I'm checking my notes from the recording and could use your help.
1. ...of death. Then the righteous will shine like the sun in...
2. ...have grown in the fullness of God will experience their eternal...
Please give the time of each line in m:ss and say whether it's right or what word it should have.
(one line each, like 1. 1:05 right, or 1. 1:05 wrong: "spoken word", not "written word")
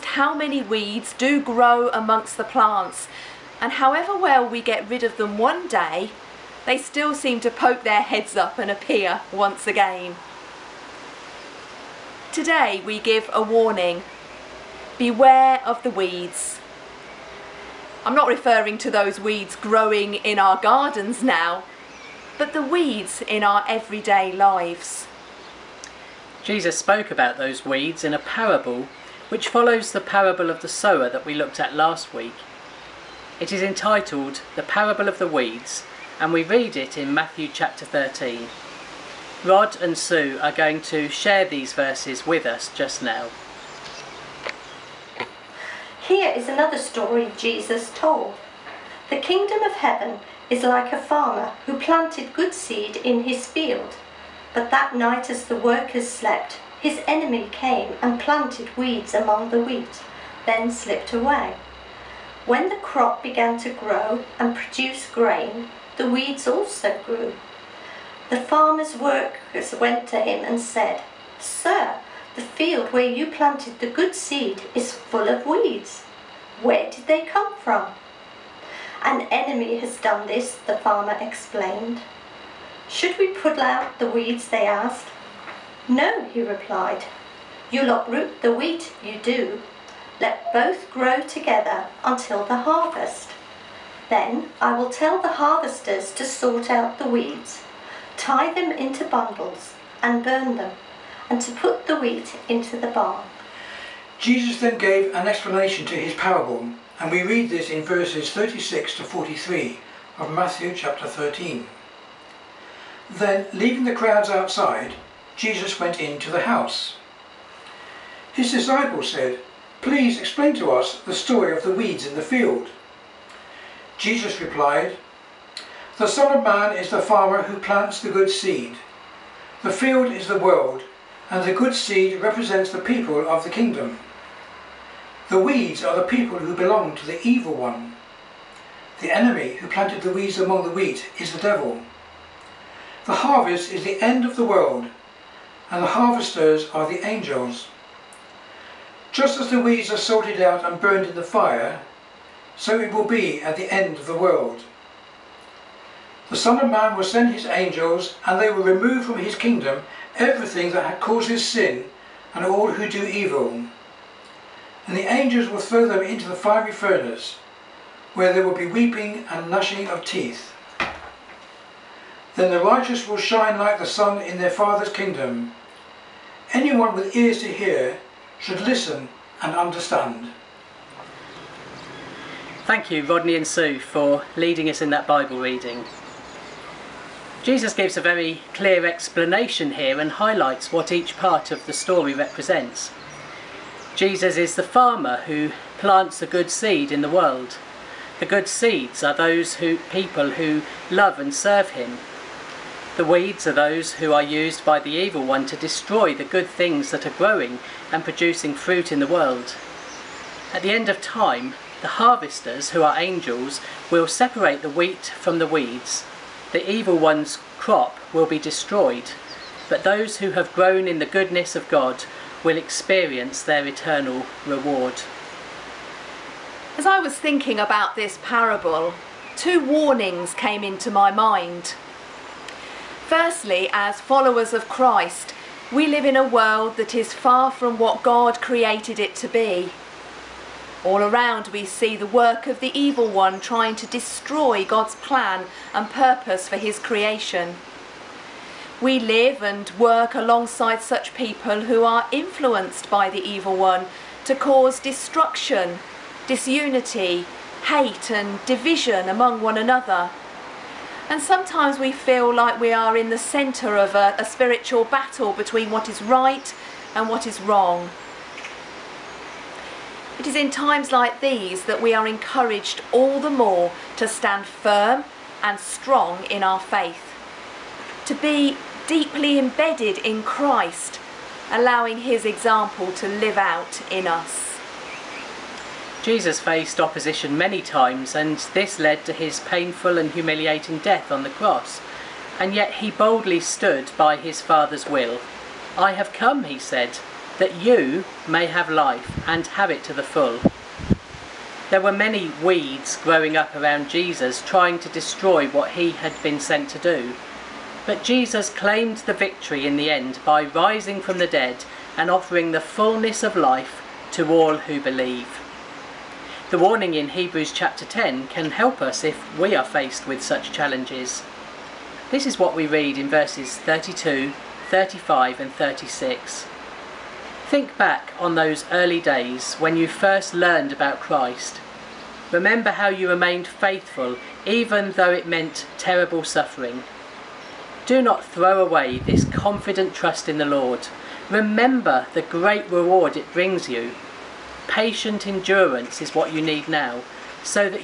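1. 2:49 wrong: "teeth", not "death"
2. 3:40 wrong: "goodness", not "fullness".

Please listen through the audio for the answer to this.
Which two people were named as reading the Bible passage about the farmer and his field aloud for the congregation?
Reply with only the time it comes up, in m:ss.
0:39.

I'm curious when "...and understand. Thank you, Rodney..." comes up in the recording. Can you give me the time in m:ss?
2:59.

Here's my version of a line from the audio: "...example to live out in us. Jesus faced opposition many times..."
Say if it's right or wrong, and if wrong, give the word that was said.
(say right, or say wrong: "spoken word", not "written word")
right.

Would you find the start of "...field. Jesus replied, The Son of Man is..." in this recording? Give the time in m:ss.
2:02.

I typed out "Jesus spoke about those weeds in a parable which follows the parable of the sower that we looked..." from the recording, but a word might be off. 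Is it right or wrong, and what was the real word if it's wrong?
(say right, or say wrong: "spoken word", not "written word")
right.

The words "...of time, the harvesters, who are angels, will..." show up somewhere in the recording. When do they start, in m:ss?
3:30.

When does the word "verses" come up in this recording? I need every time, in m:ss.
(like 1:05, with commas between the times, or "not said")
0:41, 1:47, 5:23.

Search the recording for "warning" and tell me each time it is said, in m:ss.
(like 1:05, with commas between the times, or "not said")
0:13, 3:49, 5:16.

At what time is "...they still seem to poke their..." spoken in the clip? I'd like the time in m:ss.
0:06.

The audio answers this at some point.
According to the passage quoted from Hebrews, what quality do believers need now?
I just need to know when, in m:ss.
5:44.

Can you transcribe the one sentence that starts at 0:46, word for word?
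Here is another story Jesus told.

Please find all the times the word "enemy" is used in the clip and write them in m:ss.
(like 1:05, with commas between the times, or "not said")
0:57, 1:19, 2:19.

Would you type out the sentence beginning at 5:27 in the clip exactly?
Think back on those early days when you first learned about Christ.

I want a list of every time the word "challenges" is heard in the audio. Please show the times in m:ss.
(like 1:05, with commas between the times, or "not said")
5:20.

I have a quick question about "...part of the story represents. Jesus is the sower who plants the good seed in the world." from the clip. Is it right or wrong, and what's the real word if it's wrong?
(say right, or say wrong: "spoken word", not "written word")
wrong: "farmer", not "sower".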